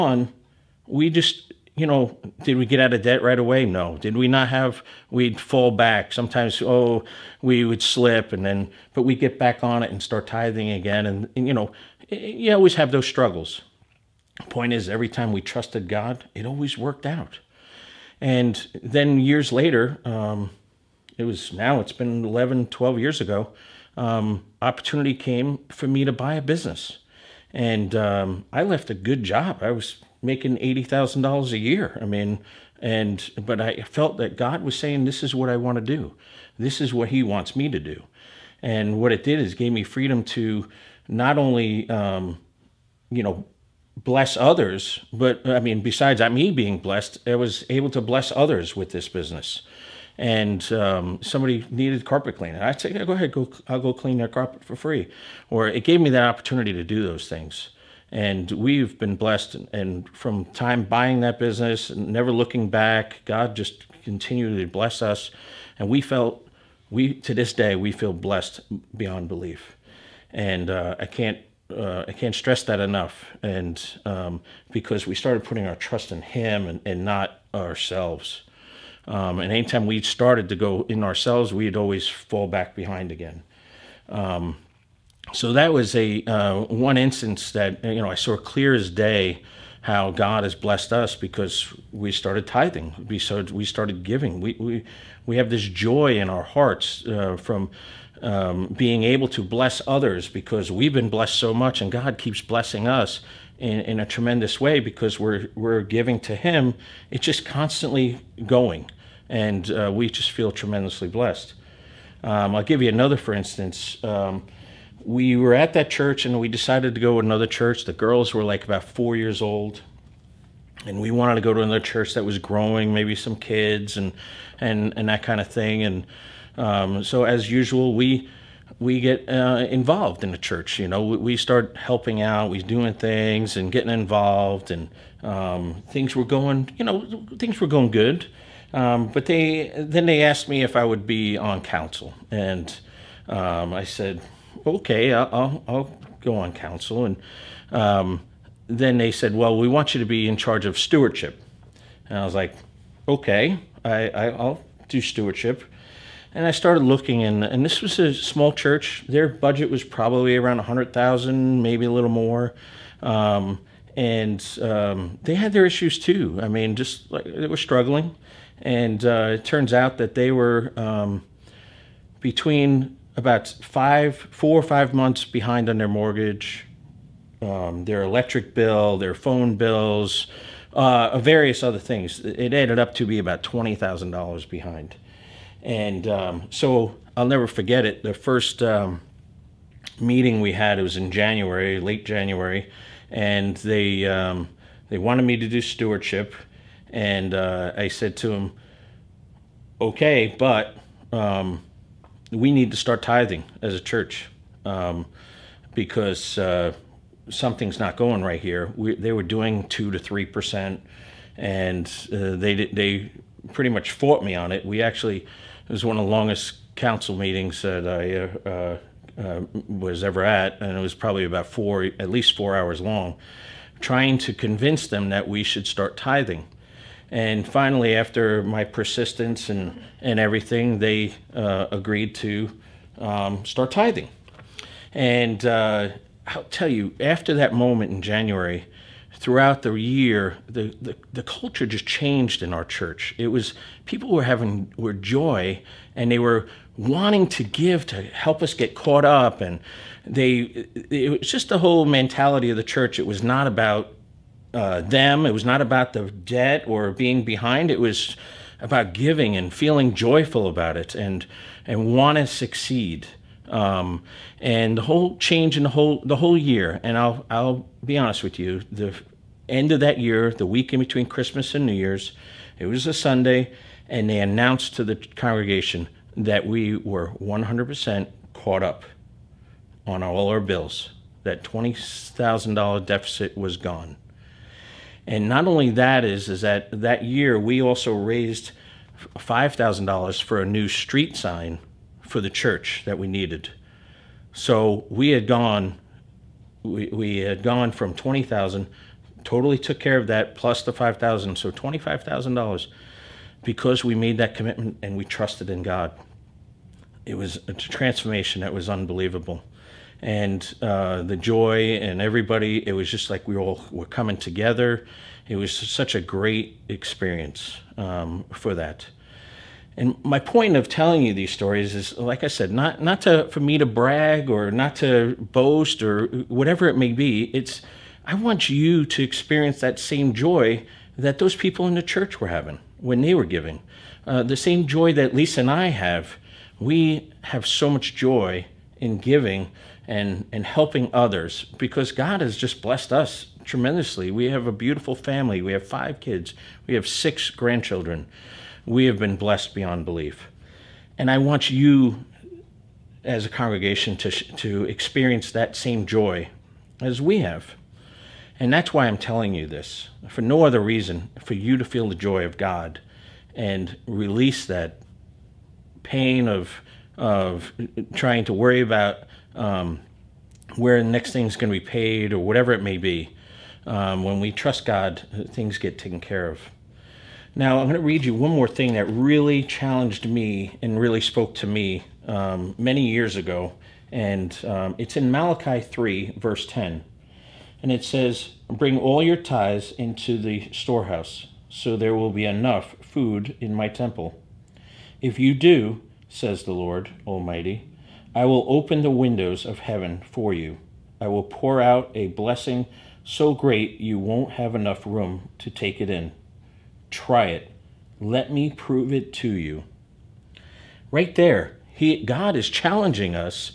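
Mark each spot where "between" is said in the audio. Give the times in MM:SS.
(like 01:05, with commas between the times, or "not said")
02:52, 04:30.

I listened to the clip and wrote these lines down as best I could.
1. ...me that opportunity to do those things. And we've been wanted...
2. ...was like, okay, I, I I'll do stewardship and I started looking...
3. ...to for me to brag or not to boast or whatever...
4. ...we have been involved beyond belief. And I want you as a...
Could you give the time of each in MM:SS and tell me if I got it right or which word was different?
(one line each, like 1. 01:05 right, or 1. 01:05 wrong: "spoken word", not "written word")
1. 00:56 wrong: "blessed", not "wanted"
2. 02:32 right
3. 05:23 right
4. 05:48 wrong: "blessed", not "involved".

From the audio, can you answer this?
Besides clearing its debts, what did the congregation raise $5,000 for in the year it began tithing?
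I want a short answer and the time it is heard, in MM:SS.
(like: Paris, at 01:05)
a new street sign, at 04:50.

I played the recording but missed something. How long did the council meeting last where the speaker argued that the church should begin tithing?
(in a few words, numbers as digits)
at least 4 hours.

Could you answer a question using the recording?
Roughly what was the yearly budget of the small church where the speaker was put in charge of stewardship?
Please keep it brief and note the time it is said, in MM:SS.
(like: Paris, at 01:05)
$100,000, at 02:40.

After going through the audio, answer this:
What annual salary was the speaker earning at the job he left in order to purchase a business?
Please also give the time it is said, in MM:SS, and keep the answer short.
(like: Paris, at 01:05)
$80,000, at 00:30.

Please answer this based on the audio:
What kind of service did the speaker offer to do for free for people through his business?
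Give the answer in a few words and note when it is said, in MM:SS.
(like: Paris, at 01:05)
carpet cleaning, at 00:52.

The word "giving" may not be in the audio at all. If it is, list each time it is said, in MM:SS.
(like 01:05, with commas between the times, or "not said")
01:34, 01:45, 04:18, 05:33, 05:38.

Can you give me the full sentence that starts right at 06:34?
If you do, says the Lord Almighty, I will open the windows of heaven for you.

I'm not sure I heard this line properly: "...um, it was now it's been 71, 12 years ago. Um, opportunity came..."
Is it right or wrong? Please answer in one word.
wrong.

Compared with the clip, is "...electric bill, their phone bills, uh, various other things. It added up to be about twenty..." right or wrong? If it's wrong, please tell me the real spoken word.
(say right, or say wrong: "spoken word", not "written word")
right.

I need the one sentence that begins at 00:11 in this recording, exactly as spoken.
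And, and, you know, you always have those struggles.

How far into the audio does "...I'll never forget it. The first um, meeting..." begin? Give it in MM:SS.
03:07.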